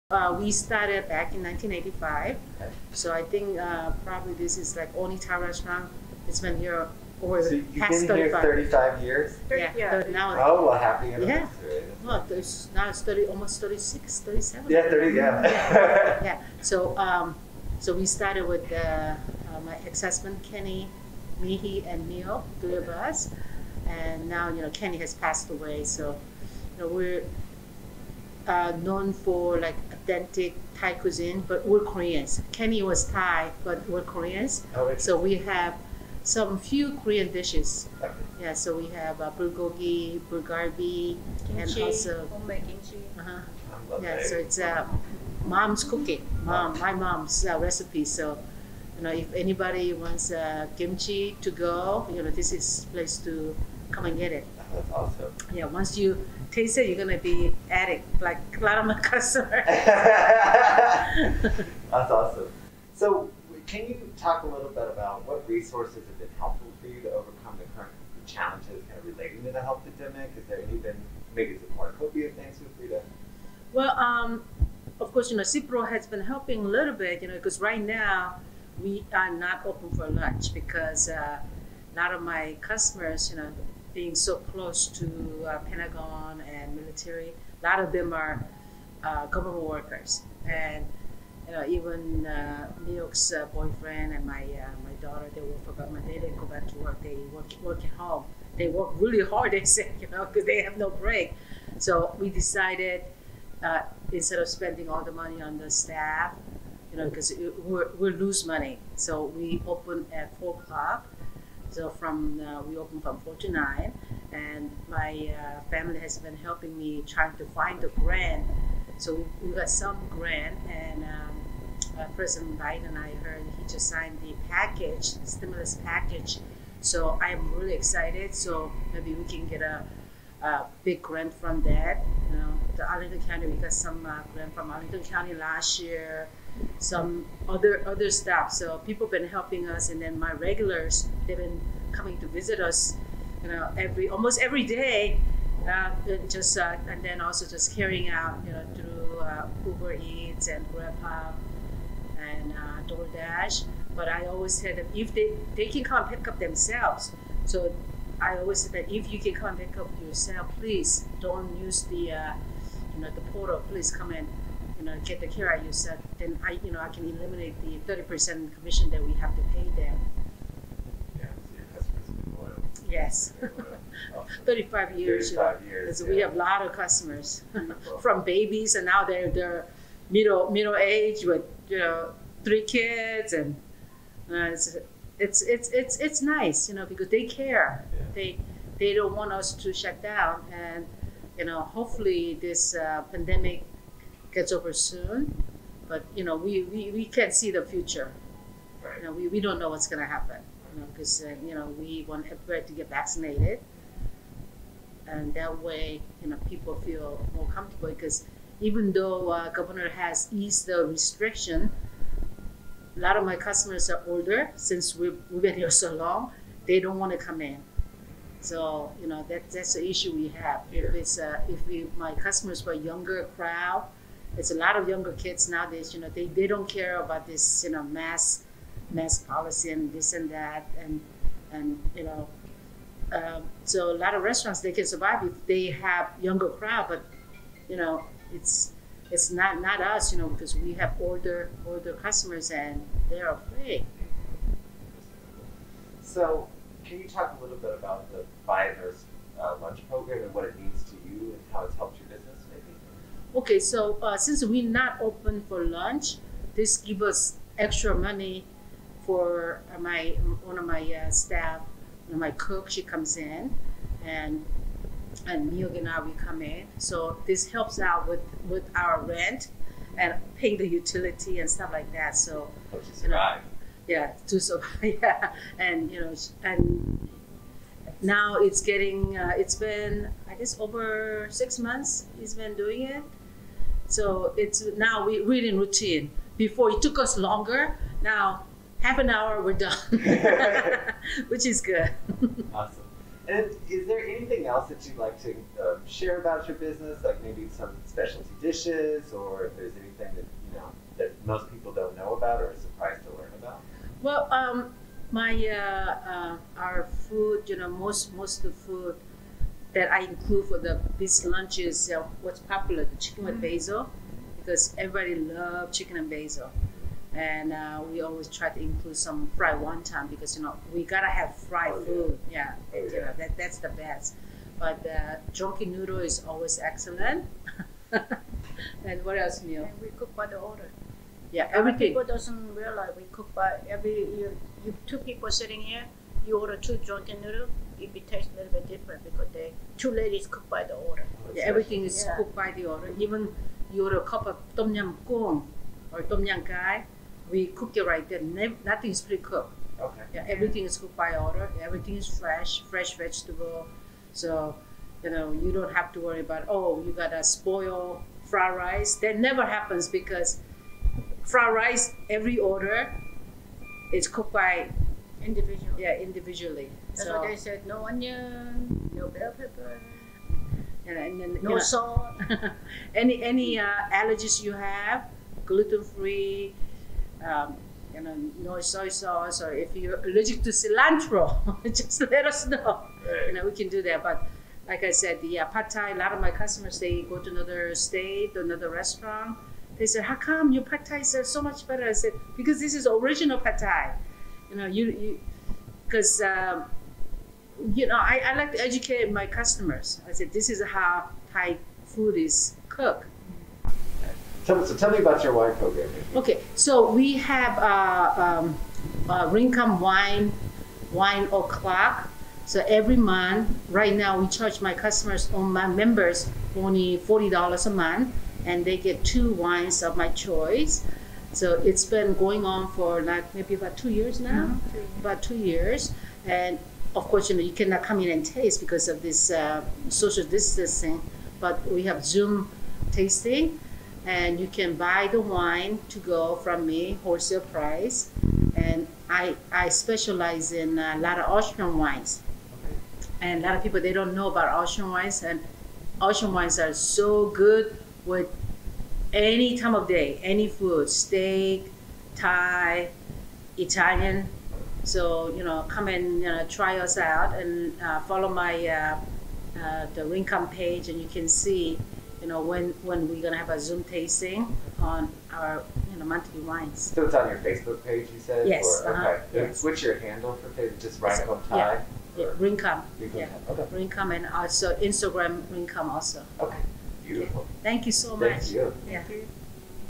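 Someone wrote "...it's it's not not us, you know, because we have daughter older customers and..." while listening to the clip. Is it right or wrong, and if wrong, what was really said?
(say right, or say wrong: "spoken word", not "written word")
wrong: "older", not "daughter".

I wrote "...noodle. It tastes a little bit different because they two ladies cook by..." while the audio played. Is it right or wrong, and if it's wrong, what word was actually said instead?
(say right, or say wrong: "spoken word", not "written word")
right.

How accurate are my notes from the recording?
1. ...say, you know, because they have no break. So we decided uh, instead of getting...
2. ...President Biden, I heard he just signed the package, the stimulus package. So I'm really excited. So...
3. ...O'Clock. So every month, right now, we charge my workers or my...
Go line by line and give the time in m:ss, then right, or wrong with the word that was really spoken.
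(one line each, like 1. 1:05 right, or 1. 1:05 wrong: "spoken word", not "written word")
1. 1:39 wrong: "spending", not "getting"
2. 2:02 right
3. 6:51 wrong: "customers", not "workers".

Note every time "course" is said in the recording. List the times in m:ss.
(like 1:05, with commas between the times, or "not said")
1:15, 7:07.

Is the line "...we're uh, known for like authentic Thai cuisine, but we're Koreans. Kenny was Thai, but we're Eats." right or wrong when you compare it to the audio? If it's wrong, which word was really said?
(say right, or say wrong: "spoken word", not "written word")
wrong: "Koreans", not "Eats".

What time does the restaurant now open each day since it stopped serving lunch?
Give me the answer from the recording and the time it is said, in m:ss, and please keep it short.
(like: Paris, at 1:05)
4 o'clock, at 1:50.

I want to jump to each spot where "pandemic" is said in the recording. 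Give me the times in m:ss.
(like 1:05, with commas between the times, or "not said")
1:09, 3:13.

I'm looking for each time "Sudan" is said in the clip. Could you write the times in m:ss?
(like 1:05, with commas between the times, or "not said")
not said.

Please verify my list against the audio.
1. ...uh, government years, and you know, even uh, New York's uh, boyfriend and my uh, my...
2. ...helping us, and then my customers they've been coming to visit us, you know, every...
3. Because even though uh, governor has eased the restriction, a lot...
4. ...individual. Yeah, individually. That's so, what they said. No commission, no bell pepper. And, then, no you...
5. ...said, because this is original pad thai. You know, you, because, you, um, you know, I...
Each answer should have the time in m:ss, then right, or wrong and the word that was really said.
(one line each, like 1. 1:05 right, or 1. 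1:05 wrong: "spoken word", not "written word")
1. 1:29 wrong: "workers", not "years"
2. 2:19 wrong: "regulars", not "customers"
3. 3:27 right
4. 6:05 wrong: "onion", not "commission"
5. 6:31 right.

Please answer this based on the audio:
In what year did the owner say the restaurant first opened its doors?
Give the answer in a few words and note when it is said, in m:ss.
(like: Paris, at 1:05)
1985, at 0:01.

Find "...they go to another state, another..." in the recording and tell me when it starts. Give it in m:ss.
6:26.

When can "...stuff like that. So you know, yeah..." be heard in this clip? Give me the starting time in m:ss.
4:31.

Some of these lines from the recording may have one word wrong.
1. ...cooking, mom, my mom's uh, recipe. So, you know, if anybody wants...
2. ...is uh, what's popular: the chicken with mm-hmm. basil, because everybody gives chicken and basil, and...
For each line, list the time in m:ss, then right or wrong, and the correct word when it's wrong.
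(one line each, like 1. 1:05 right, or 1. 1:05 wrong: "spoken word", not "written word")
1. 0:45 right
2. 5:11 wrong: "loves", not "gives".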